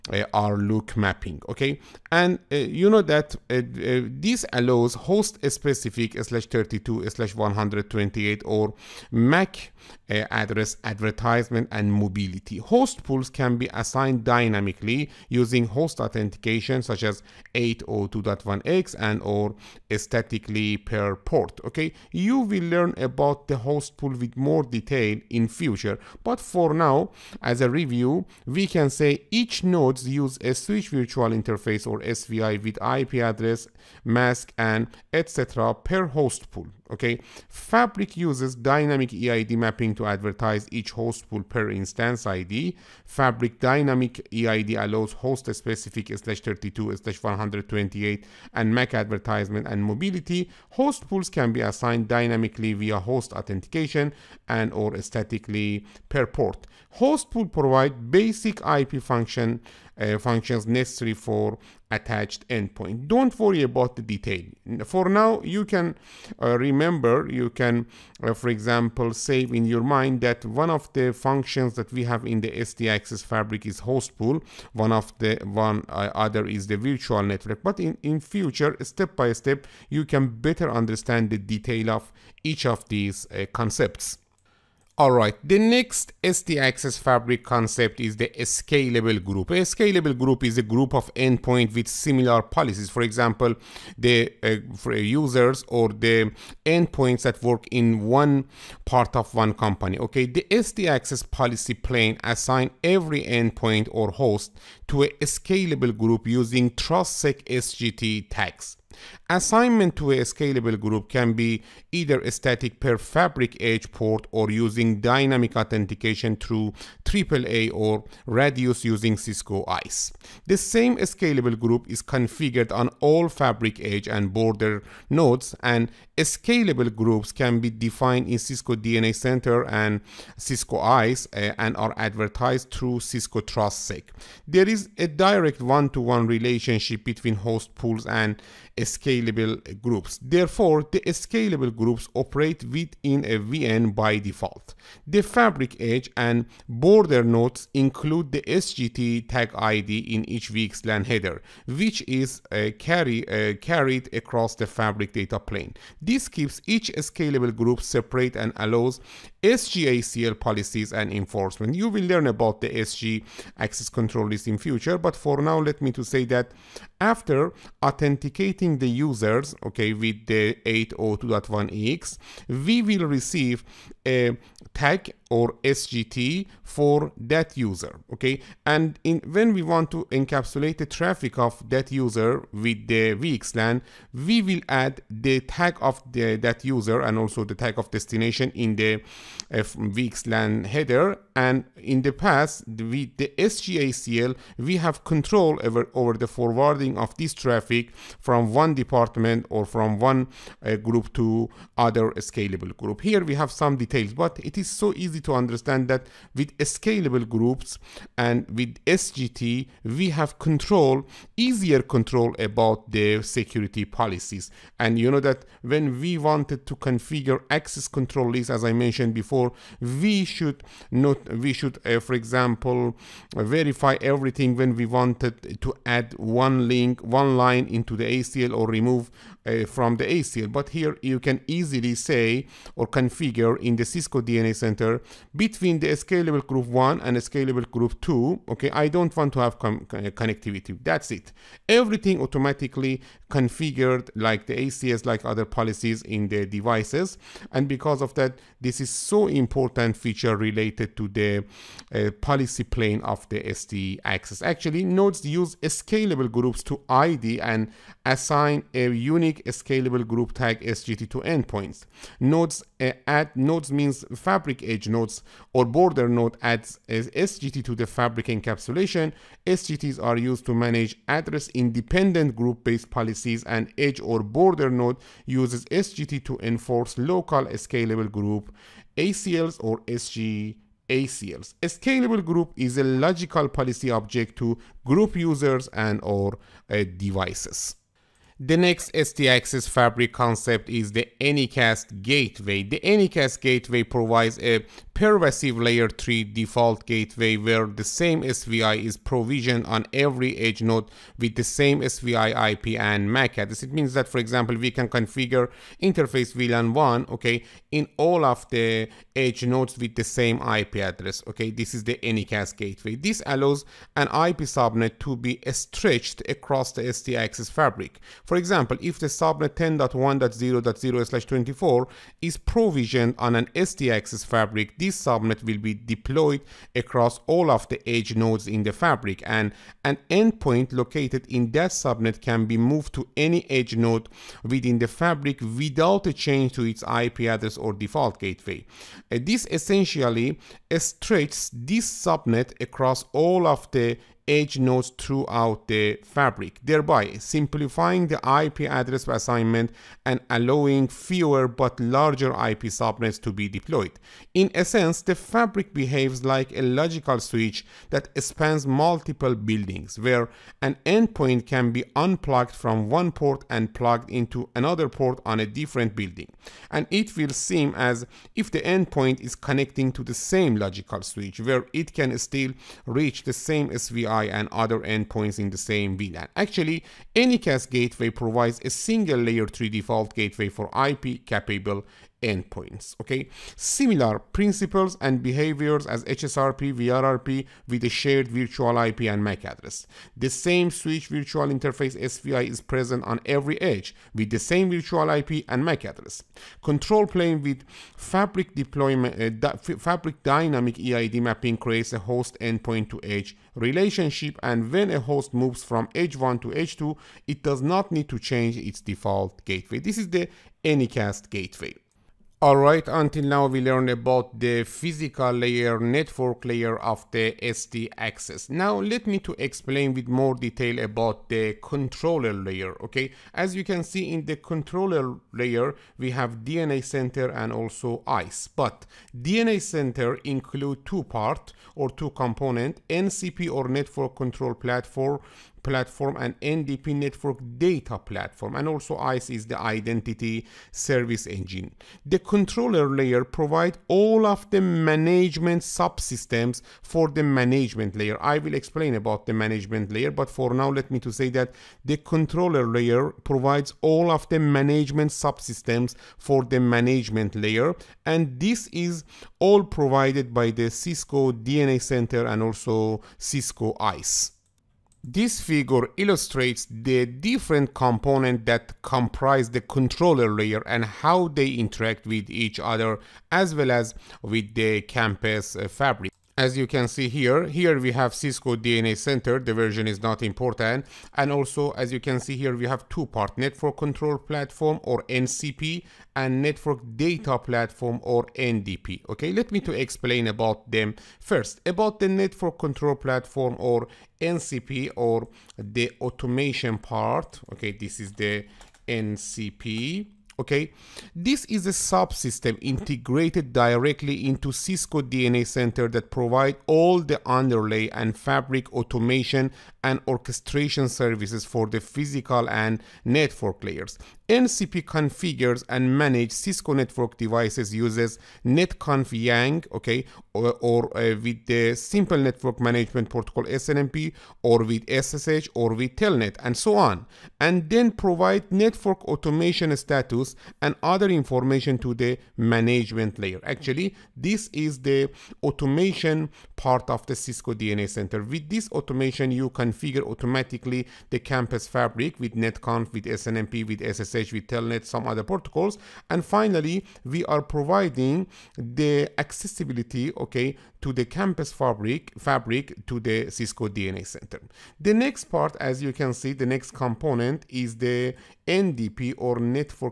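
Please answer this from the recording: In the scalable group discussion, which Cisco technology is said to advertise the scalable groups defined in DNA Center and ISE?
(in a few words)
Cisco TrustSec.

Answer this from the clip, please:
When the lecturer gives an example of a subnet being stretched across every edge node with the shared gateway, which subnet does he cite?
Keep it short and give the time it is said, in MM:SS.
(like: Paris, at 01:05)
10.1.0.0/24, at 05:19.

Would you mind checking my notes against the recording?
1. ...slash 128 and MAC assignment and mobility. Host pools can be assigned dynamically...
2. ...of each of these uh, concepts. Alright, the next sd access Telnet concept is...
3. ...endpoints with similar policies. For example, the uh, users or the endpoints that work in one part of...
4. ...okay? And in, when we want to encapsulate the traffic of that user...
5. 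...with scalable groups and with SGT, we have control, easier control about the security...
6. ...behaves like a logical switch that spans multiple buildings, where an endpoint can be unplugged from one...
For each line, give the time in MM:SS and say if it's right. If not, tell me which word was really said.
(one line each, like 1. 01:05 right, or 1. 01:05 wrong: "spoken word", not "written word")
1. 00:46 wrong: "advertisement", not "assignment"
2. 01:21 wrong: "Fabric", not "Telnet"
3. 01:31 right
4. 02:58 right
5. 03:26 right
6. 05:55 right.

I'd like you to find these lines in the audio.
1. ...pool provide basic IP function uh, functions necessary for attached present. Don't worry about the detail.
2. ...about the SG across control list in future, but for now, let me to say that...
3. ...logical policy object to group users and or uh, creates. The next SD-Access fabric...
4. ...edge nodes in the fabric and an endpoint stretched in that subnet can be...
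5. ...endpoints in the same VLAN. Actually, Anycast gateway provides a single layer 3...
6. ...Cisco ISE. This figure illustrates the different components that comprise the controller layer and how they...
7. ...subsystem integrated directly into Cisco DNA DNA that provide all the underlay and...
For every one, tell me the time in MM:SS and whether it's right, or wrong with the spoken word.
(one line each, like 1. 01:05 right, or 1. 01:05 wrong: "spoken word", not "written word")
1. 00:57 wrong: "endpoint", not "present"
2. 02:42 wrong: "access", not "across"
3. 04:42 wrong: "devices", not "creates"
4. 05:27 wrong: "located", not "stretched"
5. 06:14 right
6. 07:43 right
7. 08:21 wrong: "Center", not "DNA".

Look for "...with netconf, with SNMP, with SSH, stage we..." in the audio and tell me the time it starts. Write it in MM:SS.
09:02.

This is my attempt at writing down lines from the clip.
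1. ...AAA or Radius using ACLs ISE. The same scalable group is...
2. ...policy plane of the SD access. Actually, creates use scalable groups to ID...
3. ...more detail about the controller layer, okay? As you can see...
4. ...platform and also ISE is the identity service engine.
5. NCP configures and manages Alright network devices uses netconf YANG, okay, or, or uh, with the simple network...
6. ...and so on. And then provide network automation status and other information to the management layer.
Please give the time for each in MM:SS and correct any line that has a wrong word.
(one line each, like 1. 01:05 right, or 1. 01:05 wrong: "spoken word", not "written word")
1. 01:57 wrong: "Cisco", not "ACLs"
2. 04:12 wrong: "nodes", not "creates"
3. 07:00 right
4. 07:17 right
5. 08:34 wrong: "Cisco", not "Alright"
6. 08:46 right.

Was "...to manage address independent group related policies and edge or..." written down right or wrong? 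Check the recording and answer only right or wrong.
wrong.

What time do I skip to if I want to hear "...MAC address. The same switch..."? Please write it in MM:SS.
06:29.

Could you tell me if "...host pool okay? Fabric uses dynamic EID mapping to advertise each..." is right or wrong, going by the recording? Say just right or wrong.
right.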